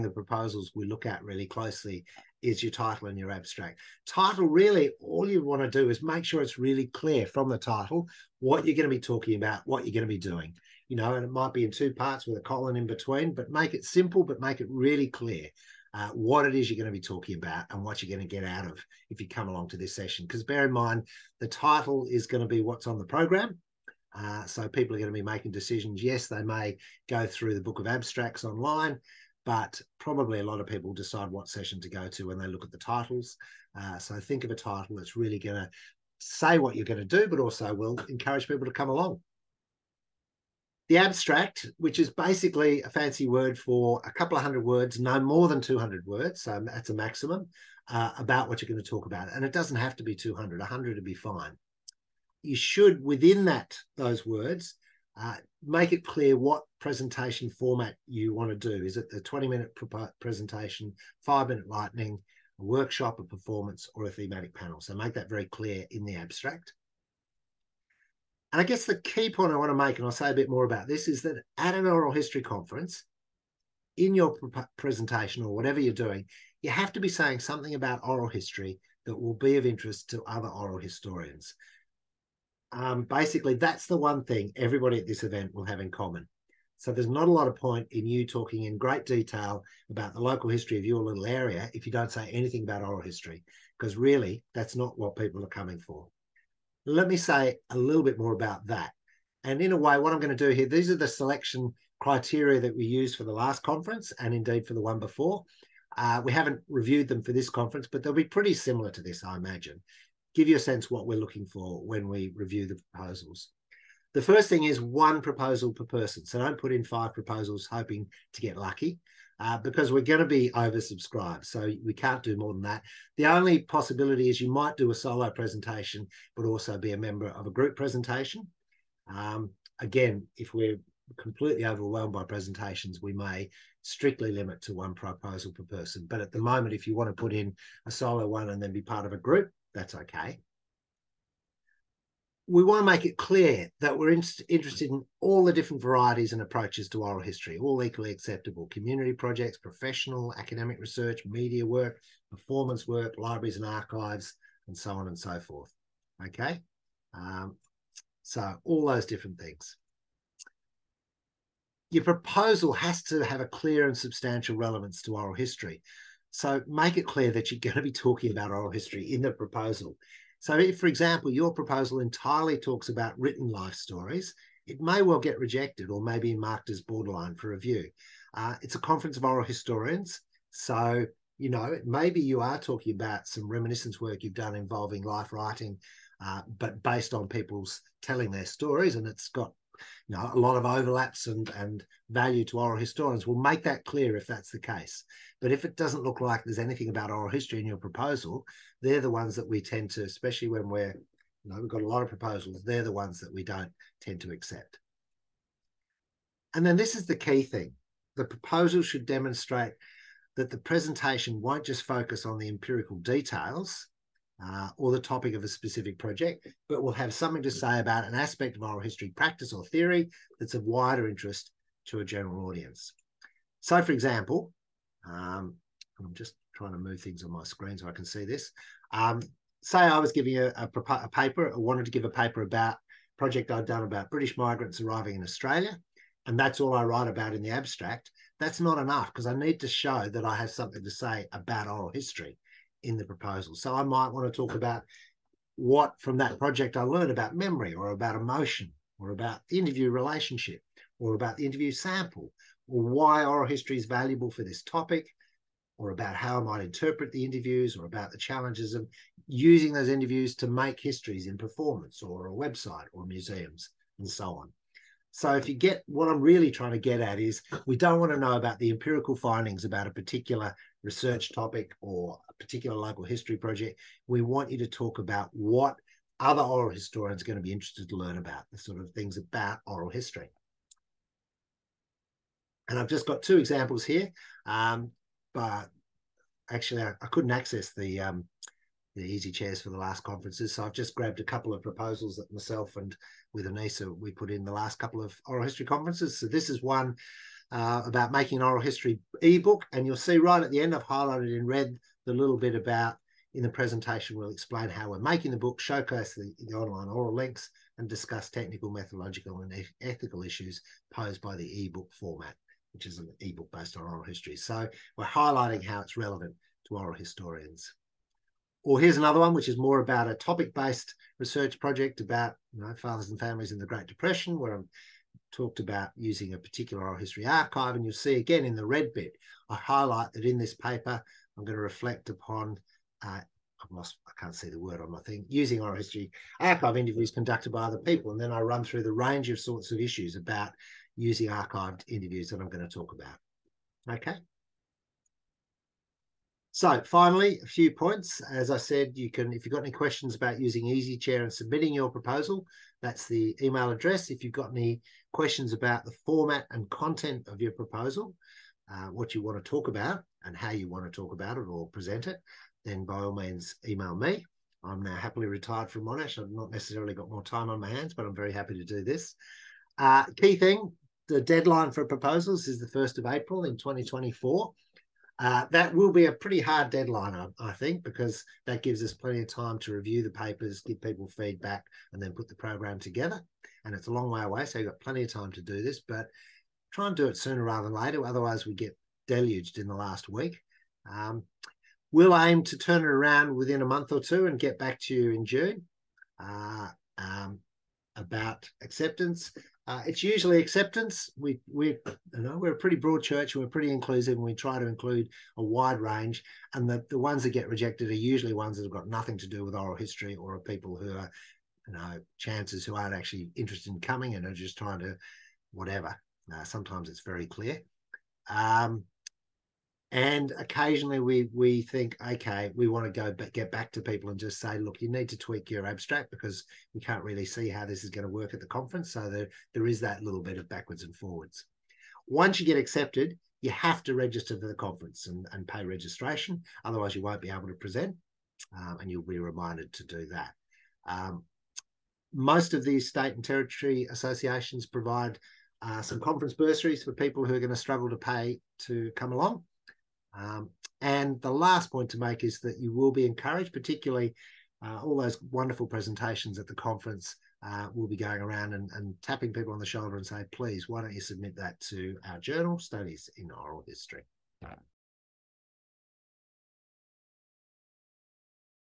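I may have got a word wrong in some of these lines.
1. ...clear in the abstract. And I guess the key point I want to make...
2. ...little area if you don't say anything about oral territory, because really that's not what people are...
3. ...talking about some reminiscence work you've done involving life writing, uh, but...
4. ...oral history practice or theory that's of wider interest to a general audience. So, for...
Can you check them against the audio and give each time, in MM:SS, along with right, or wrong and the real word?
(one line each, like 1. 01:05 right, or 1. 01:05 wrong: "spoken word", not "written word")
1. 01:05 right
2. 01:31 wrong: "history", not "territory"
3. 03:02 right
4. 03:38 right.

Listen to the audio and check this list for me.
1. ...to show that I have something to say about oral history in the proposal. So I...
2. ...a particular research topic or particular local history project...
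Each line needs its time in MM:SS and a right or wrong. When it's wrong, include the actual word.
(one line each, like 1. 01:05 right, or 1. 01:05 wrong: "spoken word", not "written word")
1. 03:59 right
2. 04:29 right.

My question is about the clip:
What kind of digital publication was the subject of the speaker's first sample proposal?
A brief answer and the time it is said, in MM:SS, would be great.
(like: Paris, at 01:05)
An ebook, at 04:58.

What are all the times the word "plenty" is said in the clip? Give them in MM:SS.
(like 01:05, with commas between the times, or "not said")
06:18, 06:24.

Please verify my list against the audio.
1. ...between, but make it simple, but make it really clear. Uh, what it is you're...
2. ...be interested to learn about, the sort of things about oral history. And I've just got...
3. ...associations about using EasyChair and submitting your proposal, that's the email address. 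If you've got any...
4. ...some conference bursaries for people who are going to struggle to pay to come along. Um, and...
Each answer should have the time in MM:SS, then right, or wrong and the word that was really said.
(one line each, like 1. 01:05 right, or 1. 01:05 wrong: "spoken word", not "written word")
1. 00:12 right
2. 04:37 right
3. 05:49 wrong: "questions", not "associations"
4. 07:25 right.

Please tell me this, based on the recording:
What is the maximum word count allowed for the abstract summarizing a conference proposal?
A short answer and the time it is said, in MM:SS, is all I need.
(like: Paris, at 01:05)
200 words, at 00:44.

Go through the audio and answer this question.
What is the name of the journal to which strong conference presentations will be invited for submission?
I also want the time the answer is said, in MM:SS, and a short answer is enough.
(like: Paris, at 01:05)
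Studies in Oral History, at 07:42.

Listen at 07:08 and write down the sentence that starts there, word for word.
So there, there is that little bit of backwards and forwards.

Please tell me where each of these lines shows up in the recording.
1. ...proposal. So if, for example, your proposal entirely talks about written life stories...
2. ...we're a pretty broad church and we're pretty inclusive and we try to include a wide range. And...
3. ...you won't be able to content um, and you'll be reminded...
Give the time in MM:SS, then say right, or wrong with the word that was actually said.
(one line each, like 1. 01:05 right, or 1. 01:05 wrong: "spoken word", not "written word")
1. 02:49 right
2. 06:42 right
3. 07:16 wrong: "present", not "content".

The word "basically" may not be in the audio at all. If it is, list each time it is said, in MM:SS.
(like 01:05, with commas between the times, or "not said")
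00:42, 01:23.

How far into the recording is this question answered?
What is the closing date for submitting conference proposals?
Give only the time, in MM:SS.
06:12.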